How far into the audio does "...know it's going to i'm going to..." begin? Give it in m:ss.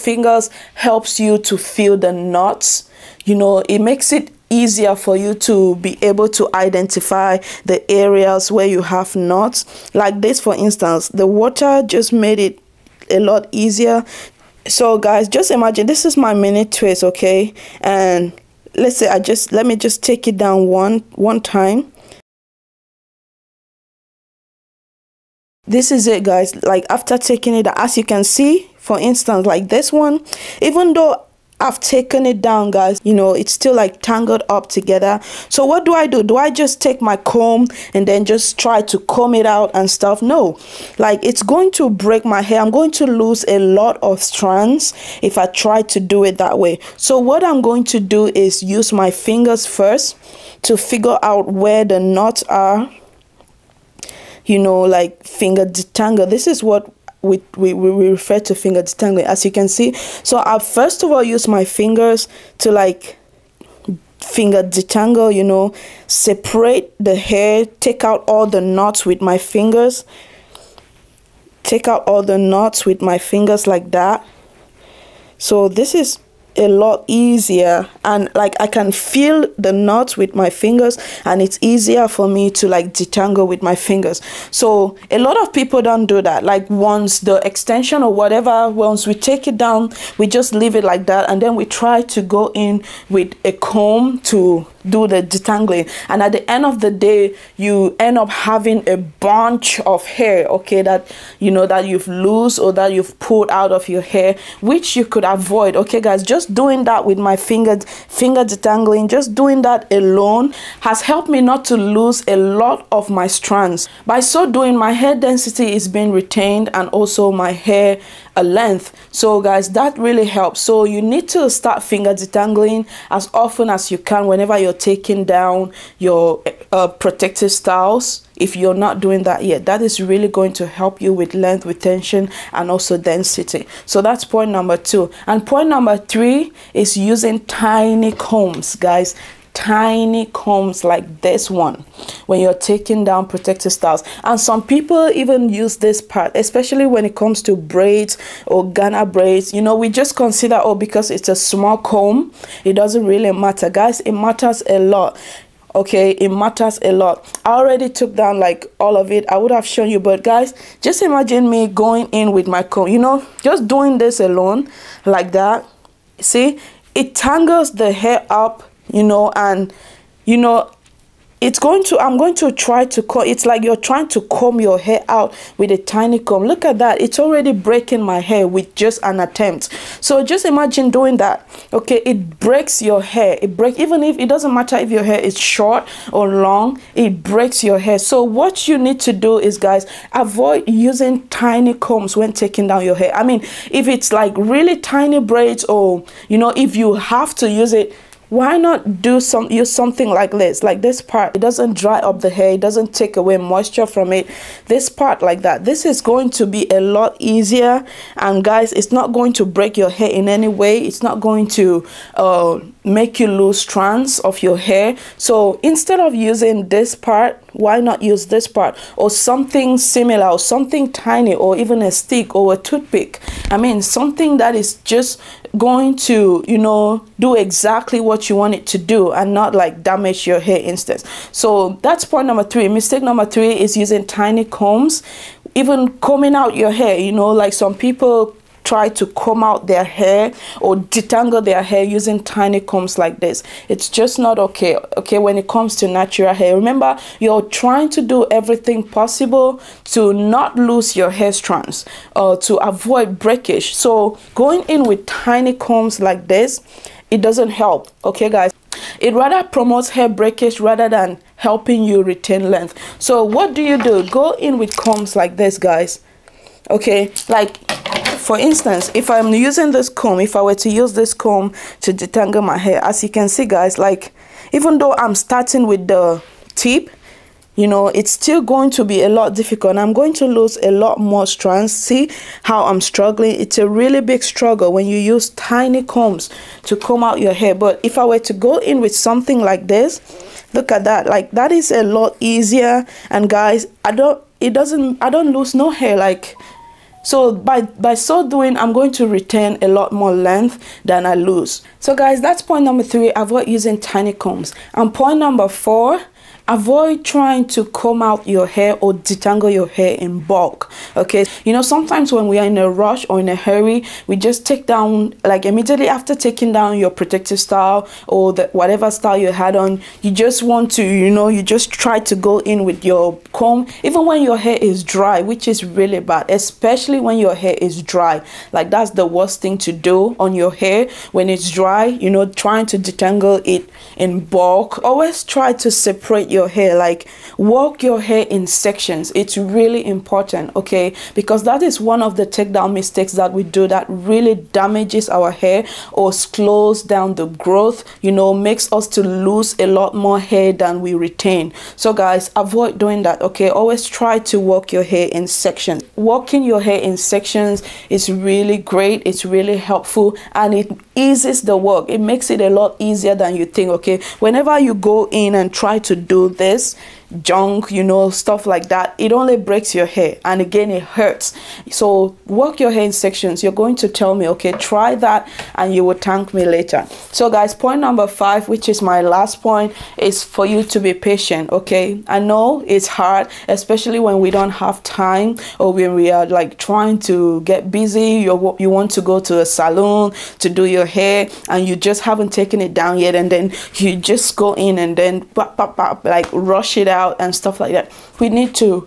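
2:50.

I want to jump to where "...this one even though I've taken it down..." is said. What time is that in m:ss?
0:29.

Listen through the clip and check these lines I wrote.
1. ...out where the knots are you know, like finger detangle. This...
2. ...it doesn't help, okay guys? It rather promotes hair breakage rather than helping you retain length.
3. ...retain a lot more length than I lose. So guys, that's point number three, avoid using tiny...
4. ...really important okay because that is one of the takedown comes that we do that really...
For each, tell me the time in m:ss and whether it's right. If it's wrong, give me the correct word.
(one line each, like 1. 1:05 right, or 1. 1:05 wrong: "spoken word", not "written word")
1. 0:51 right
2. 4:17 right
3. 4:59 right
4. 5:39 wrong: "mistakes", not "comes".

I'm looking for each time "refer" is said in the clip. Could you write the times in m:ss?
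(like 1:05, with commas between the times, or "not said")
0:58.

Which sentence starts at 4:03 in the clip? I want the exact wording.
It's just not okay, okay, when it comes to natural hair.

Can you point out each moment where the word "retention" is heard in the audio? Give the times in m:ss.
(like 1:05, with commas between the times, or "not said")
2:11.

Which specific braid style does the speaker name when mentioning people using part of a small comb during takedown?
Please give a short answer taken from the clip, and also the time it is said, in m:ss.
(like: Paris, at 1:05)
Ghana braids, at 2:28.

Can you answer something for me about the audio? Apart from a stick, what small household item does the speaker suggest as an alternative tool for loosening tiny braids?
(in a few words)
A toothpick.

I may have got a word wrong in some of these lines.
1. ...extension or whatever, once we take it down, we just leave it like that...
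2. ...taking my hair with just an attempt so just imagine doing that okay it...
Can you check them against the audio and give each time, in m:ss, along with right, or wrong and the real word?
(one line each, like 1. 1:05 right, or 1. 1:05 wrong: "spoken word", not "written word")
1. 1:27 right
2. 2:57 wrong: "breaking", not "taking".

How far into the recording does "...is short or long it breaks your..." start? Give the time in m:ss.
3:05.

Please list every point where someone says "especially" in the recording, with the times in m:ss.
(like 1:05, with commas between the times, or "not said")
2:26, 5:26, 6:23.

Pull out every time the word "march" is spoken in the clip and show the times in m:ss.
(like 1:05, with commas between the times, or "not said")
not said.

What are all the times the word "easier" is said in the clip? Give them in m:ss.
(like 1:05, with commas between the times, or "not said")
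0:04, 0:13, 1:17, 1:21, 3:27, 4:52, 6:02.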